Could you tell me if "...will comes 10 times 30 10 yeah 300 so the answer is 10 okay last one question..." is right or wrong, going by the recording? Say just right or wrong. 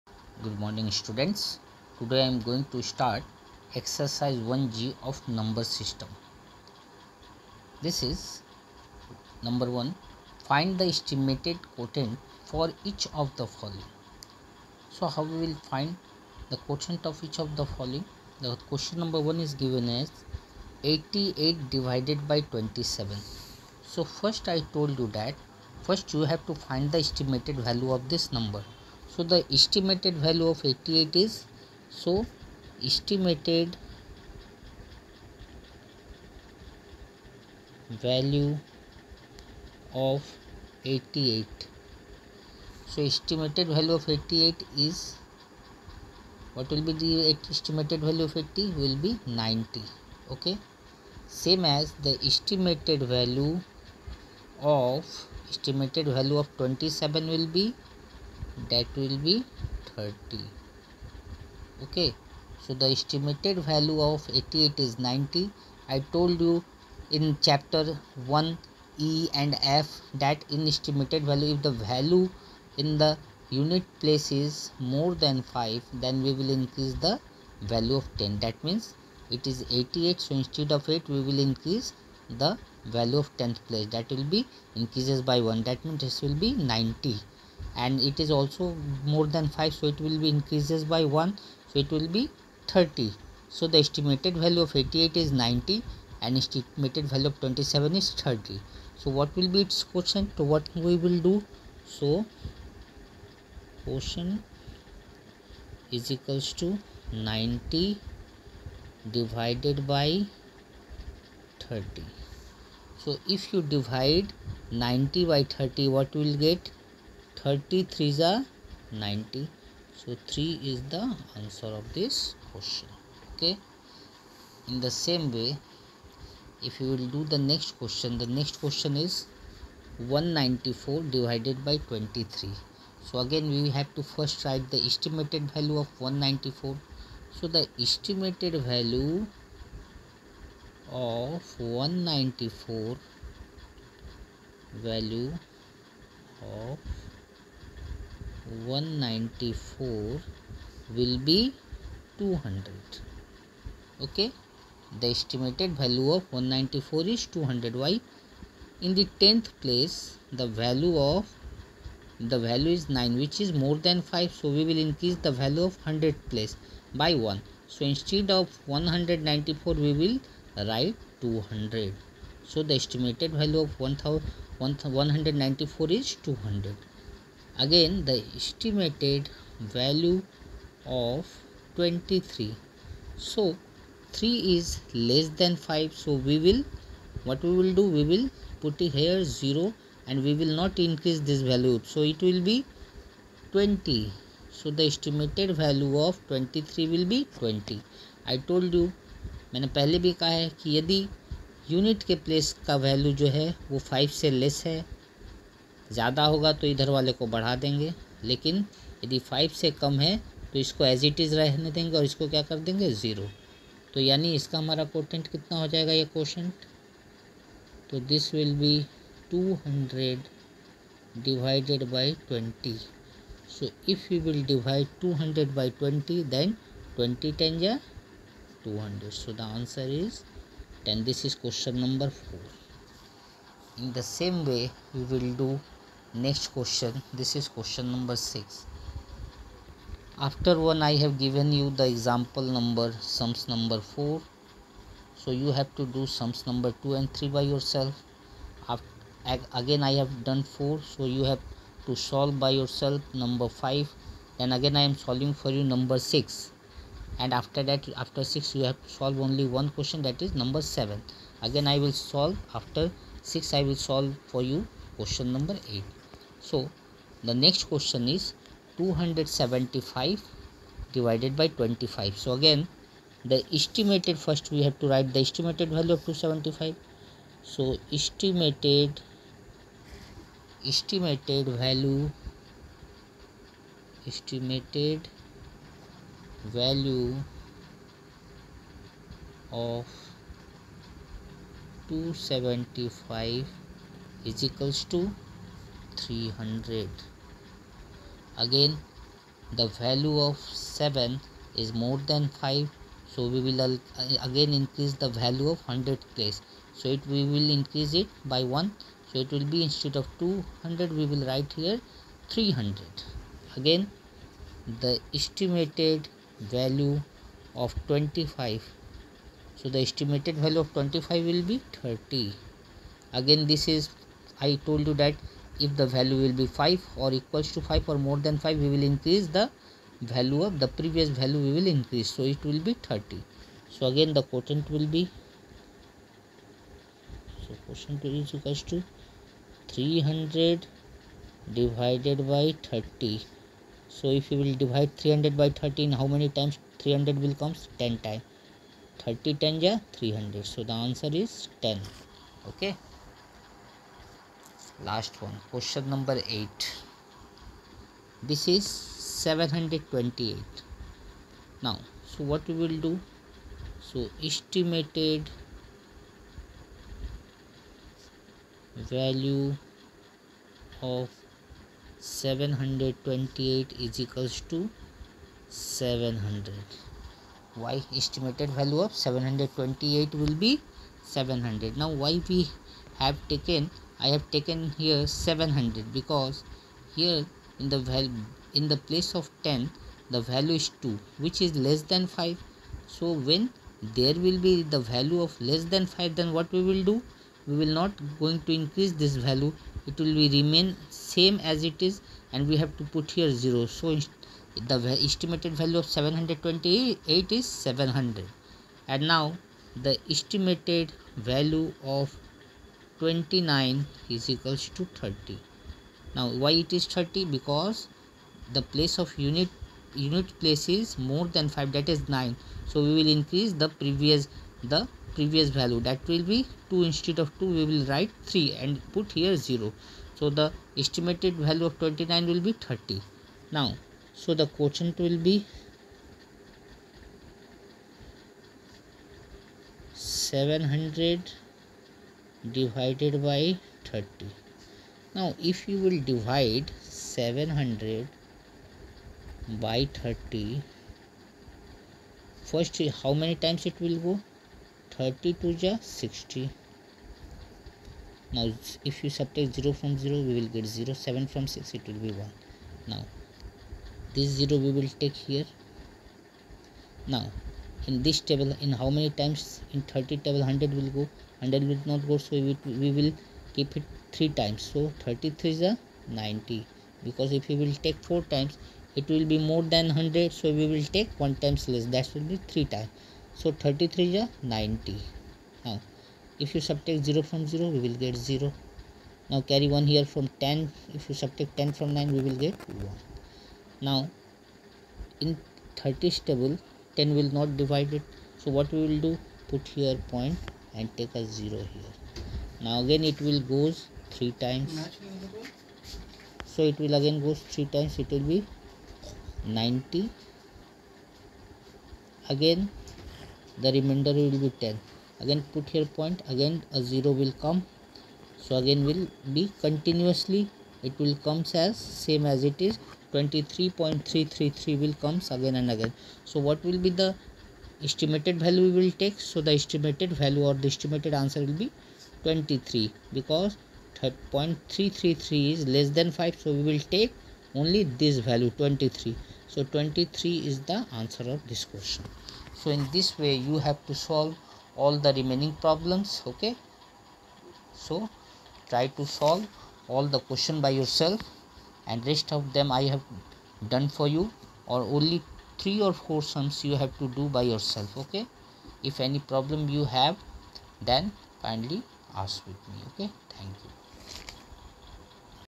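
right.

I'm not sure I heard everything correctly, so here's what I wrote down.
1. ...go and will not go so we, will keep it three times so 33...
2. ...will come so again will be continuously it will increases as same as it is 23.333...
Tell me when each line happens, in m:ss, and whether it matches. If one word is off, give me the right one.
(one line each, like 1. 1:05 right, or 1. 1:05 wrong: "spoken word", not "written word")
1. 7:51 right
2. 8:37 wrong: "comes", not "increases".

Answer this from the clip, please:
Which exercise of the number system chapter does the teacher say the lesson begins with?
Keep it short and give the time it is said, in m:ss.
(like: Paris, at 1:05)
1g, at 0:03.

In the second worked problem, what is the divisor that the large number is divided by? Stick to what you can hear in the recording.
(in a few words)
23.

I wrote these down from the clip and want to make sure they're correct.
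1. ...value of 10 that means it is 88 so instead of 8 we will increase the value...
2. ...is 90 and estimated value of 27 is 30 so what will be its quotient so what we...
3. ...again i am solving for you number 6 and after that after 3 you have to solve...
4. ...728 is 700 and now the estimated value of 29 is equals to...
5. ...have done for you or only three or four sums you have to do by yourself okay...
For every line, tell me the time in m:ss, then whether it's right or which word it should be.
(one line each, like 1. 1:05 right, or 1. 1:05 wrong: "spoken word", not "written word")
1. 1:17 right
2. 1:35 right
3. 4:14 wrong: "6", not "3"
4. 6:45 right
5. 9:12 right.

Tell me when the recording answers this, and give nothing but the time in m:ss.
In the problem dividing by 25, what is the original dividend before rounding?
4:28.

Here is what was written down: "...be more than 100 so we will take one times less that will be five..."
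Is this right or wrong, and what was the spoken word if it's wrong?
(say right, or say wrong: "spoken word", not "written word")
wrong: "three", not "five".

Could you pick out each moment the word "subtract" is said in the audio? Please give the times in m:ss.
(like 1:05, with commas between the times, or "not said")
7:39, 8:06, 8:11.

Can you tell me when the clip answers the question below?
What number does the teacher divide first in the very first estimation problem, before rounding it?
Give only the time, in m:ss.
0:20.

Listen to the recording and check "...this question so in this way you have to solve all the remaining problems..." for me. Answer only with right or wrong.
right.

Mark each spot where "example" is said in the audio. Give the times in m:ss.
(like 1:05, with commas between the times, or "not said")
4:01.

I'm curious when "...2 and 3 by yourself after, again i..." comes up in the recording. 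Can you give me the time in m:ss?
4:06.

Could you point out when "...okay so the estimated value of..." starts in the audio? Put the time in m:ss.
1:01.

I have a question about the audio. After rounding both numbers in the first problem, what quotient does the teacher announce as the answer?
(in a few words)
3.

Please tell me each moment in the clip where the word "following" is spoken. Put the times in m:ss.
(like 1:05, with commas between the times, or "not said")
0:13, 0:17.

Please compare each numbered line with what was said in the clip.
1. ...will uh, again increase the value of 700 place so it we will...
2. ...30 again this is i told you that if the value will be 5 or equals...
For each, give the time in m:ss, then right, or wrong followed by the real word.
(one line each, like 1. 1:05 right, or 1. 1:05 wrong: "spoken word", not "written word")
1. 5:03 wrong: "100", not "700"
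2. 5:21 right.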